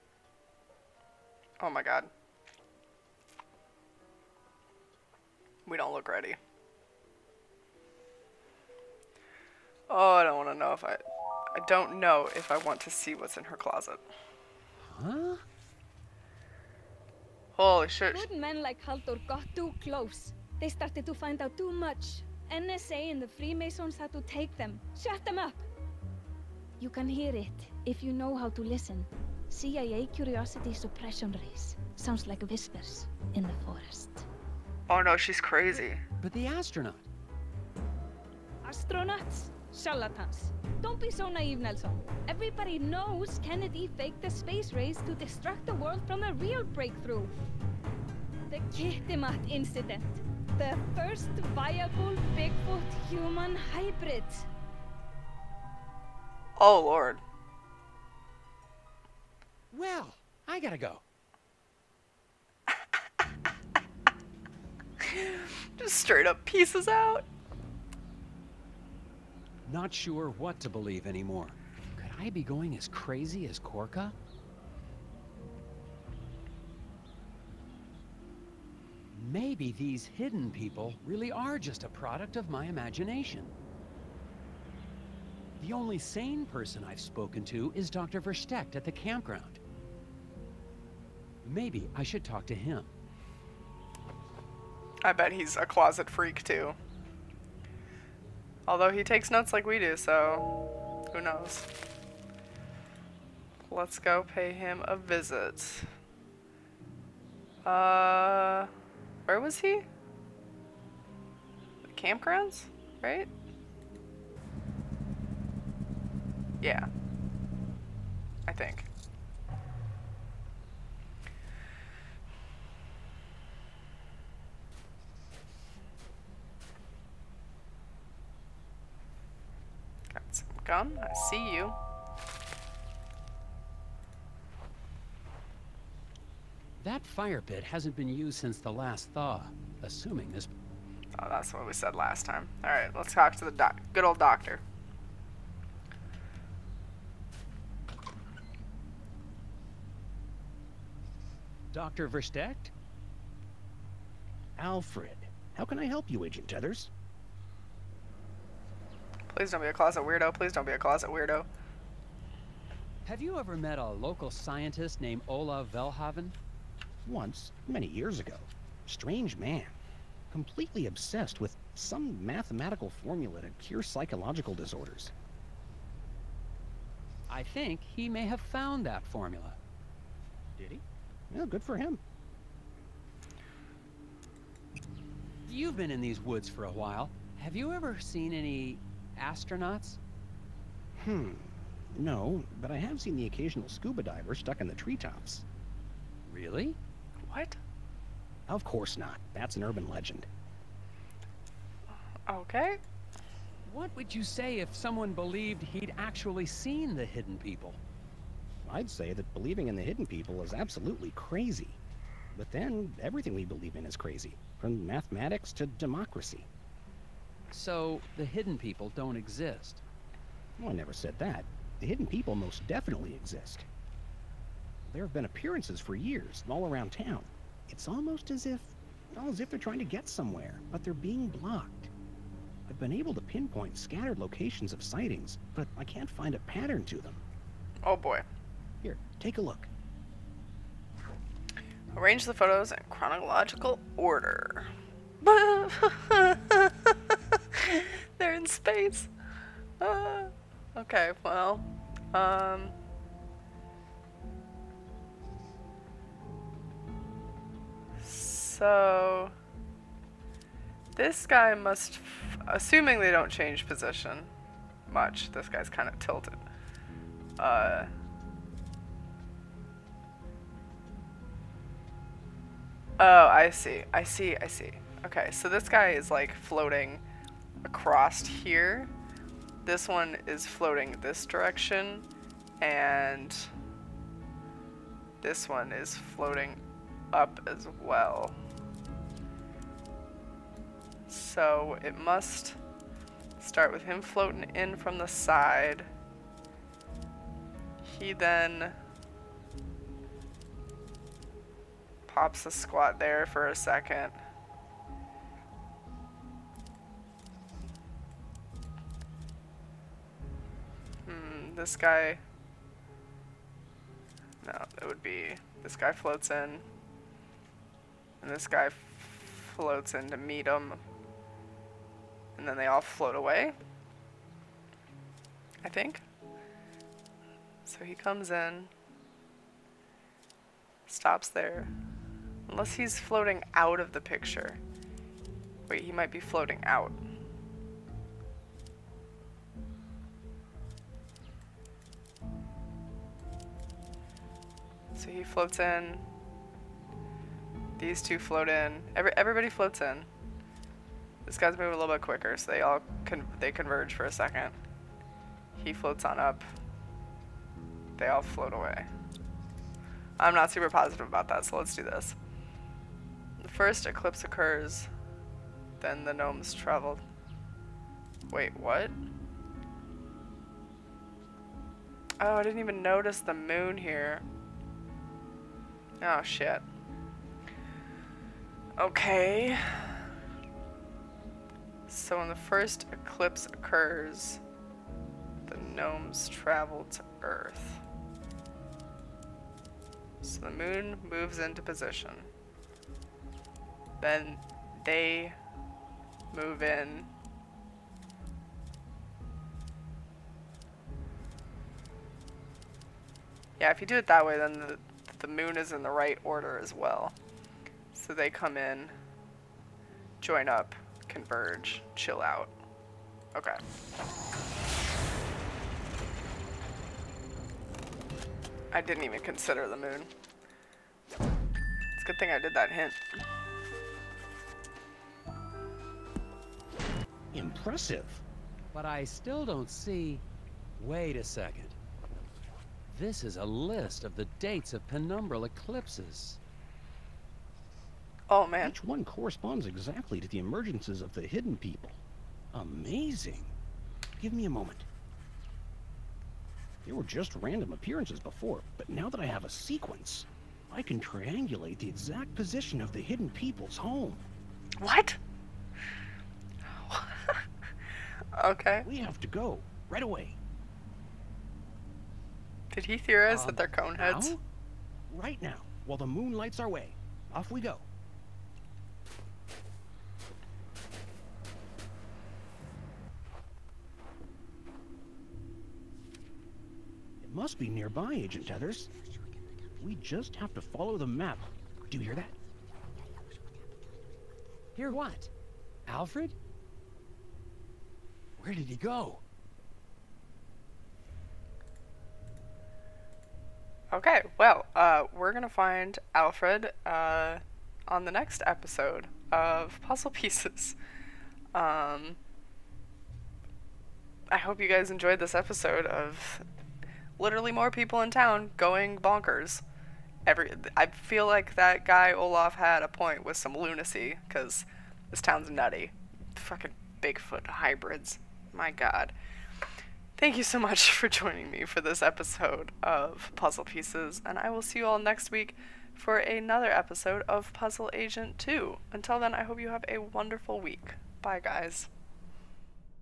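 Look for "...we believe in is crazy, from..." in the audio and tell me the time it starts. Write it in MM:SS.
03:33.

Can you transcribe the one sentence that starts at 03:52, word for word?
I've been able to pinpoint scattered locations of sightings, but I can't find a pattern to them.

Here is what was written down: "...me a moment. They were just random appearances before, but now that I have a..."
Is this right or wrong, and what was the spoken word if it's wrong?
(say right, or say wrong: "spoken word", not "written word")
right.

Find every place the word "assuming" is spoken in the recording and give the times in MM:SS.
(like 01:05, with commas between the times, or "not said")
02:19, 04:22.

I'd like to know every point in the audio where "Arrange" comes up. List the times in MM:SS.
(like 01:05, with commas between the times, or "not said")
04:01.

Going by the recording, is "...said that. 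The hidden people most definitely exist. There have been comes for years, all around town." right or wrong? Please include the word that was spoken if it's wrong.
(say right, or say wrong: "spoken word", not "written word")
wrong: "appearances", not "comes".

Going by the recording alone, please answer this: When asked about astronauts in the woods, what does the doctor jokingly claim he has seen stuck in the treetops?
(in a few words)
scuba diver.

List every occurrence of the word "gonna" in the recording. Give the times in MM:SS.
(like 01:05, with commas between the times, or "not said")
08:15.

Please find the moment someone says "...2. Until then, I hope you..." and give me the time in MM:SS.
08:48.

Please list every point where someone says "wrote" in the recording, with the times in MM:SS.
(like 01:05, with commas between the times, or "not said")
not said.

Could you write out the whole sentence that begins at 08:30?
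Every I feel like that guy Olaf had a point with some lunacy because this town's nutty.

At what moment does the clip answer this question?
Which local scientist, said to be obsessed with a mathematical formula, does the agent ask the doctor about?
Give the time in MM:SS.
02:45.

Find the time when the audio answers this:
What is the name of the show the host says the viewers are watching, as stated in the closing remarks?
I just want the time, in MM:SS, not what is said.
08:43.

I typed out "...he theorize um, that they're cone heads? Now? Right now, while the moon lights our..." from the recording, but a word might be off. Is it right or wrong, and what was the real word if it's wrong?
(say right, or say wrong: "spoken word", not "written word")
right.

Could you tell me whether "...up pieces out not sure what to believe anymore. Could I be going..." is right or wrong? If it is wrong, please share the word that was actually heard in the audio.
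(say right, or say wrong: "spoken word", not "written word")
right.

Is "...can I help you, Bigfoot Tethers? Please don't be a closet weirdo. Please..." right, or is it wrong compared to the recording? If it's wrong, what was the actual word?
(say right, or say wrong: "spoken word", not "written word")
wrong: "Agent", not "Bigfoot".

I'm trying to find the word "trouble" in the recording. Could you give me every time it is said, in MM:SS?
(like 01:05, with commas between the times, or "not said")
not said.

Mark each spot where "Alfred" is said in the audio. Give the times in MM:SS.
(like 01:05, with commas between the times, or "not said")
02:34, 08:05, 08:16.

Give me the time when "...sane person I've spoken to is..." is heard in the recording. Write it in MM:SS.
01:25.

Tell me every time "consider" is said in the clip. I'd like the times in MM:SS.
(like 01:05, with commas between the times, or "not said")
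06:59.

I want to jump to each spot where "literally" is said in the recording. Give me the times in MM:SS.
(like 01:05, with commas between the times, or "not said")
08:27.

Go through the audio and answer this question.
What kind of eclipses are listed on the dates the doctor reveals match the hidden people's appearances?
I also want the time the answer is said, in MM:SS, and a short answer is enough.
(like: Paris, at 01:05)
penumbral, at 07:14.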